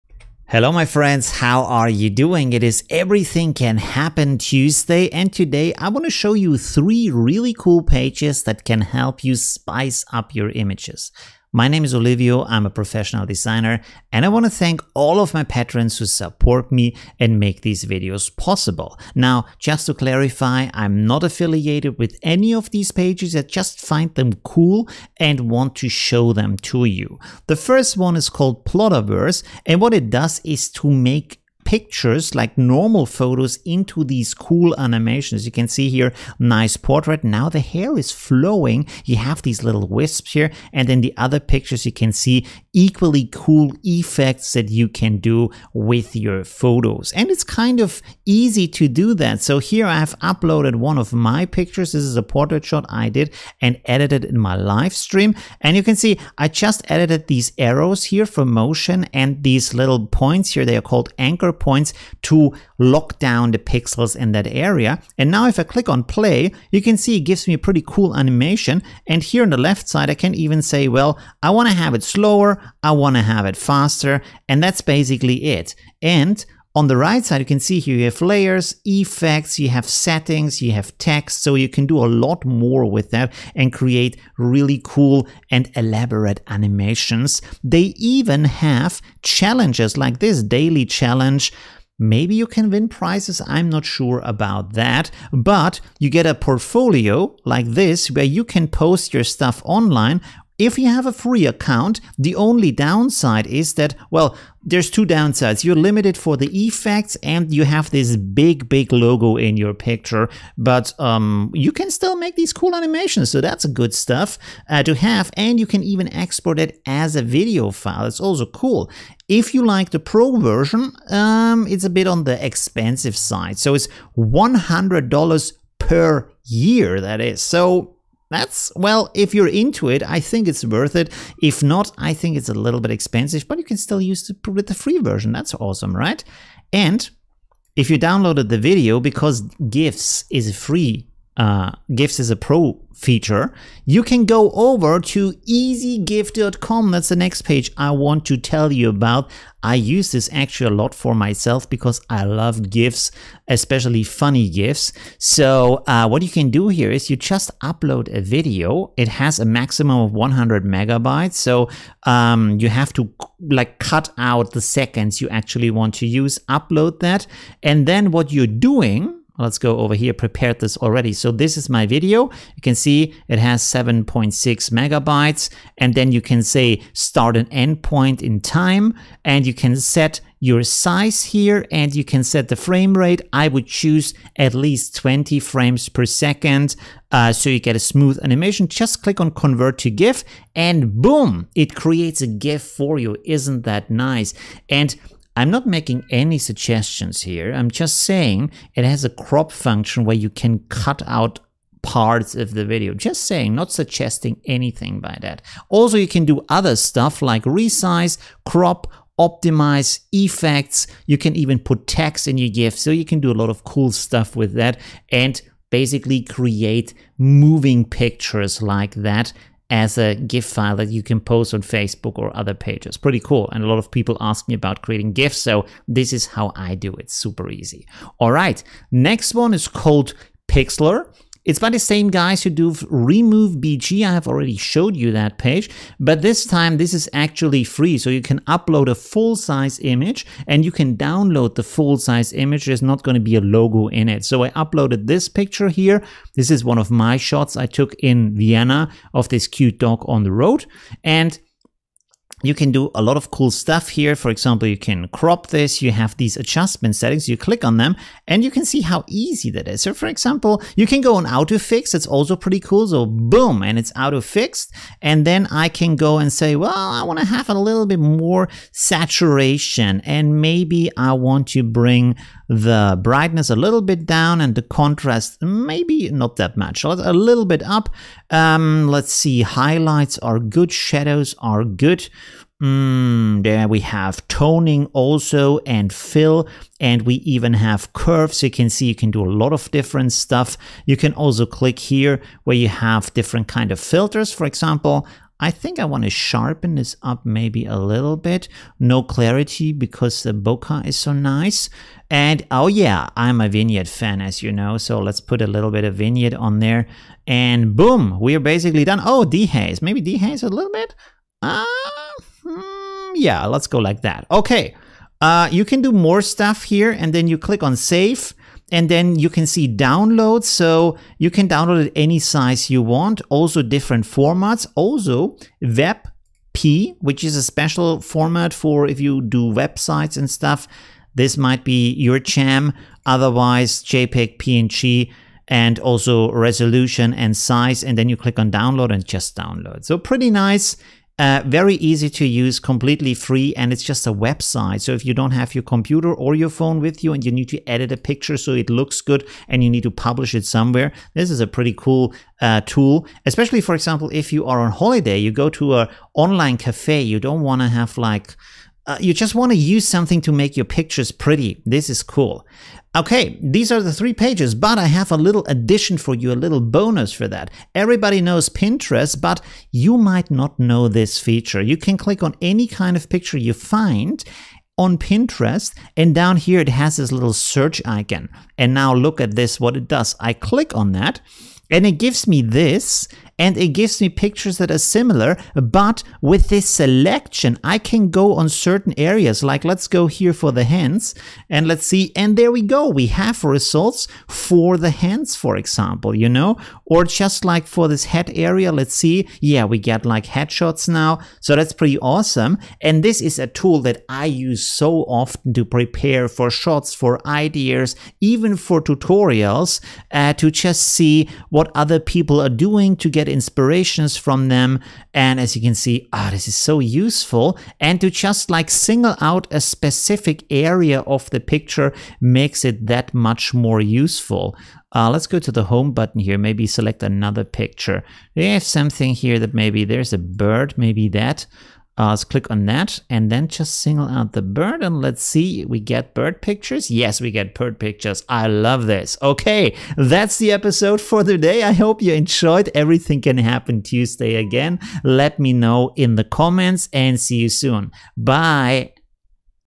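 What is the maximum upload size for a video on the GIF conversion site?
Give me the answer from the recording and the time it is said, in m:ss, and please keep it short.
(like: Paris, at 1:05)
100 megabytes, at 2:40.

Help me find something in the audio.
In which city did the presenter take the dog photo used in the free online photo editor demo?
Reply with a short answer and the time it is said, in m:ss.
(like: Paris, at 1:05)
Vienna, at 4:08.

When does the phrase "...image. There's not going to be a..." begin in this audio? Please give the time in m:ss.
4:02.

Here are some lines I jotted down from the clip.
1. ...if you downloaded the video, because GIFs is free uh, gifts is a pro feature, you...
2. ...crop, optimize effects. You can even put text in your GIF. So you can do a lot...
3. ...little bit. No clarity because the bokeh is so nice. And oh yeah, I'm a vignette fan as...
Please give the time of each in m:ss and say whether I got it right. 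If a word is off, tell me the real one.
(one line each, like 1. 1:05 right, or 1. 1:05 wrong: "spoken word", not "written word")
1. 2:17 right
2. 3:28 right
3. 4:57 right.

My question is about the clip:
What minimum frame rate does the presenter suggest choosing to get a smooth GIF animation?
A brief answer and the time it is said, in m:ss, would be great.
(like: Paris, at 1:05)
20 frames per second, at 3:04.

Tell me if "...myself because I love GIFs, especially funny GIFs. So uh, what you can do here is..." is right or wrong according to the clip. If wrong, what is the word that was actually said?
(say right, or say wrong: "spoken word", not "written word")
right.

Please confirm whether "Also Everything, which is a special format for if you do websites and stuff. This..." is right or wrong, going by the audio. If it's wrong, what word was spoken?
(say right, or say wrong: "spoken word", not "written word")
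wrong: "WebP", not "Everything".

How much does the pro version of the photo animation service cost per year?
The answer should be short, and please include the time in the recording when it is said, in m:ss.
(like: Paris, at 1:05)
$100, at 2:04.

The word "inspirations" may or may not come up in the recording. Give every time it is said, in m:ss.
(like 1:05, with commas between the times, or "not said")
6:53.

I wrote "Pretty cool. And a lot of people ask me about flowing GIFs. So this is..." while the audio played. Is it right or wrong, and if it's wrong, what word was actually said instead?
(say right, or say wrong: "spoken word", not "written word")
wrong: "creating", not "flowing".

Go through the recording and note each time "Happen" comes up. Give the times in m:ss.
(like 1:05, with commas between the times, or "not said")
0:03, 7:23.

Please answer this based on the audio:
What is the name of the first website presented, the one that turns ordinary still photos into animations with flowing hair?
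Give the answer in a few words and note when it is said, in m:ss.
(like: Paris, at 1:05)
Plotaverse, at 0:28.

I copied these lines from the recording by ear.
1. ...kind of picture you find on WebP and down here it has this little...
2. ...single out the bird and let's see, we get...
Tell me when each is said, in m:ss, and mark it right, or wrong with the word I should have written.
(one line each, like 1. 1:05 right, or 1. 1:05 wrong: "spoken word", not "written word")
1. 6:12 wrong: "Pinterest", not "WebP"
2. 7:13 right.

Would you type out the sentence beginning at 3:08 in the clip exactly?
Just click on convert to GIF and boom, it creates a GIF for you.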